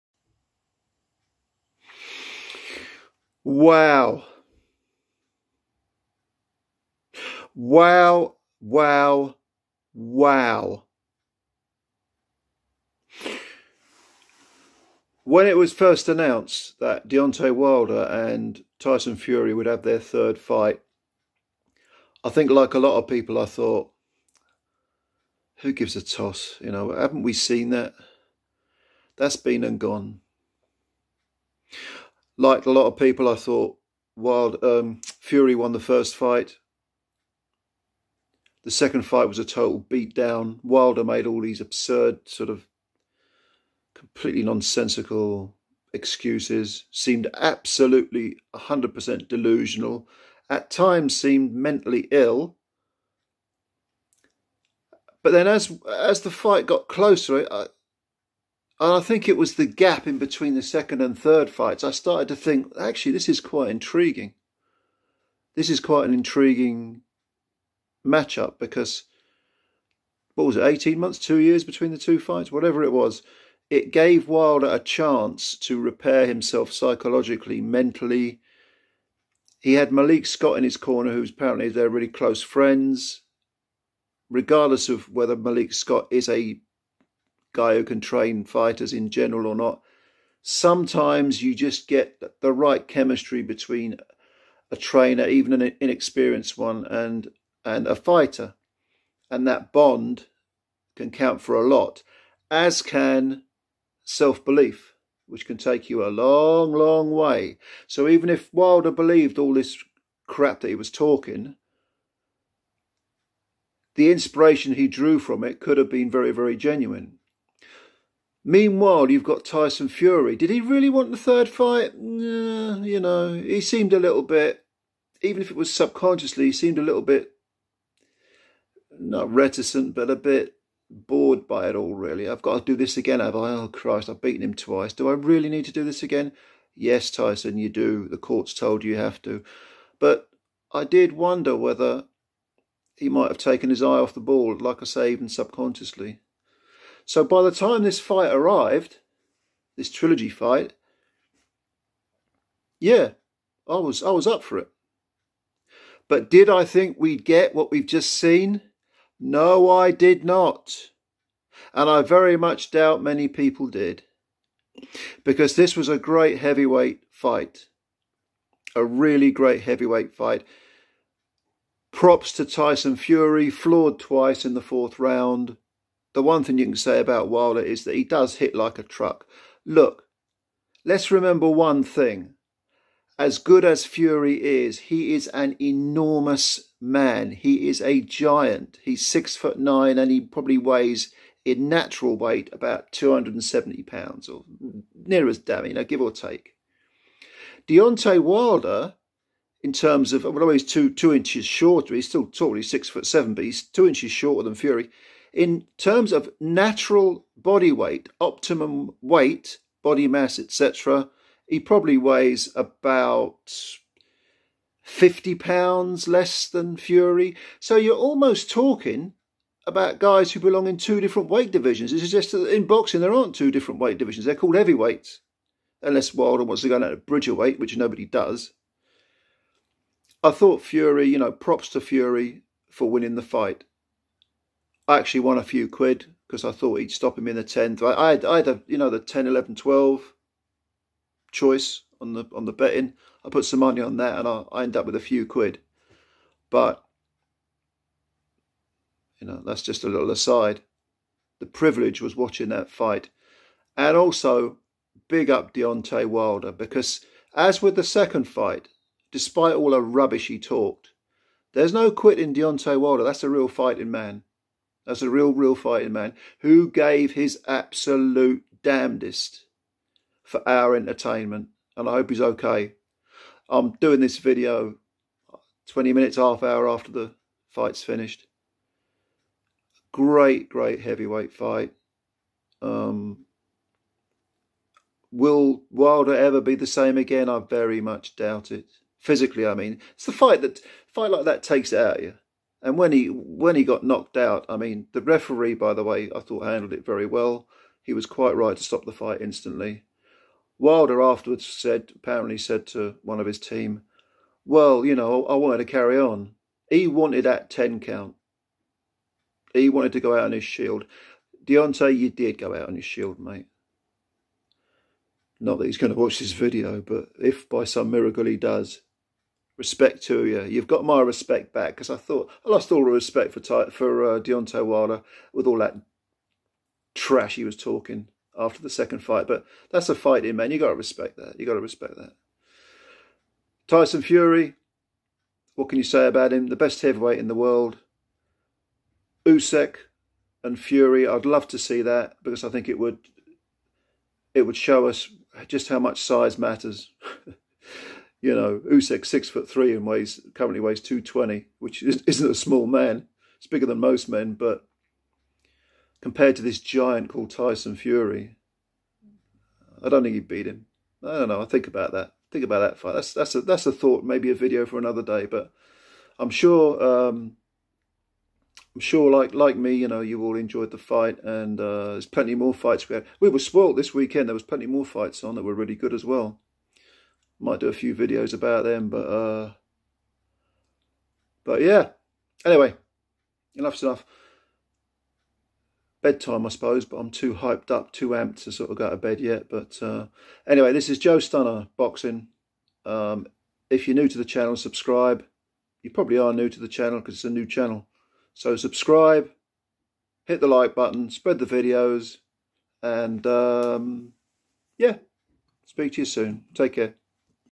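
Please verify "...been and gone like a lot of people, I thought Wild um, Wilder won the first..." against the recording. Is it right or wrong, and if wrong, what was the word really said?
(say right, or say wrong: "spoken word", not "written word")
wrong: "Fury", not "Wilder".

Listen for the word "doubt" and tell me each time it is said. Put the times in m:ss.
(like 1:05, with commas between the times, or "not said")
2:42, 4:48.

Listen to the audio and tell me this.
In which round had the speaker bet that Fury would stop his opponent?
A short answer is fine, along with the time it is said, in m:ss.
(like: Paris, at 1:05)
10th, at 3:57.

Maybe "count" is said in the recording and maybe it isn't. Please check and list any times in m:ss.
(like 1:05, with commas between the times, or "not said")
1:41, 5:07.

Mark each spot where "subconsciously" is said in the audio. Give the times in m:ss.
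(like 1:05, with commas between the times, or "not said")
2:05, 2:25.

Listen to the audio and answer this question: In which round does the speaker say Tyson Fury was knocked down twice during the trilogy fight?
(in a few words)
4th.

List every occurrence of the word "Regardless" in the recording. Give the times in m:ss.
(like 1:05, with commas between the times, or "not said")
1:24.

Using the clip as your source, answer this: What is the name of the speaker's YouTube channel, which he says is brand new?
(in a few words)
Joe Stunner Boxing.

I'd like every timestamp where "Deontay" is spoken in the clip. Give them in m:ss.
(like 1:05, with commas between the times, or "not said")
0:17, 3:17, 4:15, 4:22, 5:11, 5:24.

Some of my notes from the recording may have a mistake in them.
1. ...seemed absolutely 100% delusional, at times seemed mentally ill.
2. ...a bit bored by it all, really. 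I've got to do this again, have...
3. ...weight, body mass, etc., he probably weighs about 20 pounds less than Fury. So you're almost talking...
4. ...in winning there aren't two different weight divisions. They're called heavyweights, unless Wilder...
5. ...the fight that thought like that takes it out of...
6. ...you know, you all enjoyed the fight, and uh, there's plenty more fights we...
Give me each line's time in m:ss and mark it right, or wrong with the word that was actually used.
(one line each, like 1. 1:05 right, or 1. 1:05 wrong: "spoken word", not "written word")
1. 0:46 right
2. 2:10 right
3. 3:29 wrong: "50", not "20"
4. 3:42 wrong: "boxing", not "winning"
5. 4:50 wrong: "fight", not "thought"
6. 6:09 right.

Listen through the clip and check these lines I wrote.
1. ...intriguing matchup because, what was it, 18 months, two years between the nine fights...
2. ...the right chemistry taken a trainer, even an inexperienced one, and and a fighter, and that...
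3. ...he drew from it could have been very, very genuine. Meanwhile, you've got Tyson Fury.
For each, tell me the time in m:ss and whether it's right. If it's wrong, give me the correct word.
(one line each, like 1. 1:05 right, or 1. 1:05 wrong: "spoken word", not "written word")
1. 1:06 wrong: "two", not "nine"
2. 1:32 wrong: "between", not "taken"
3. 1:54 right.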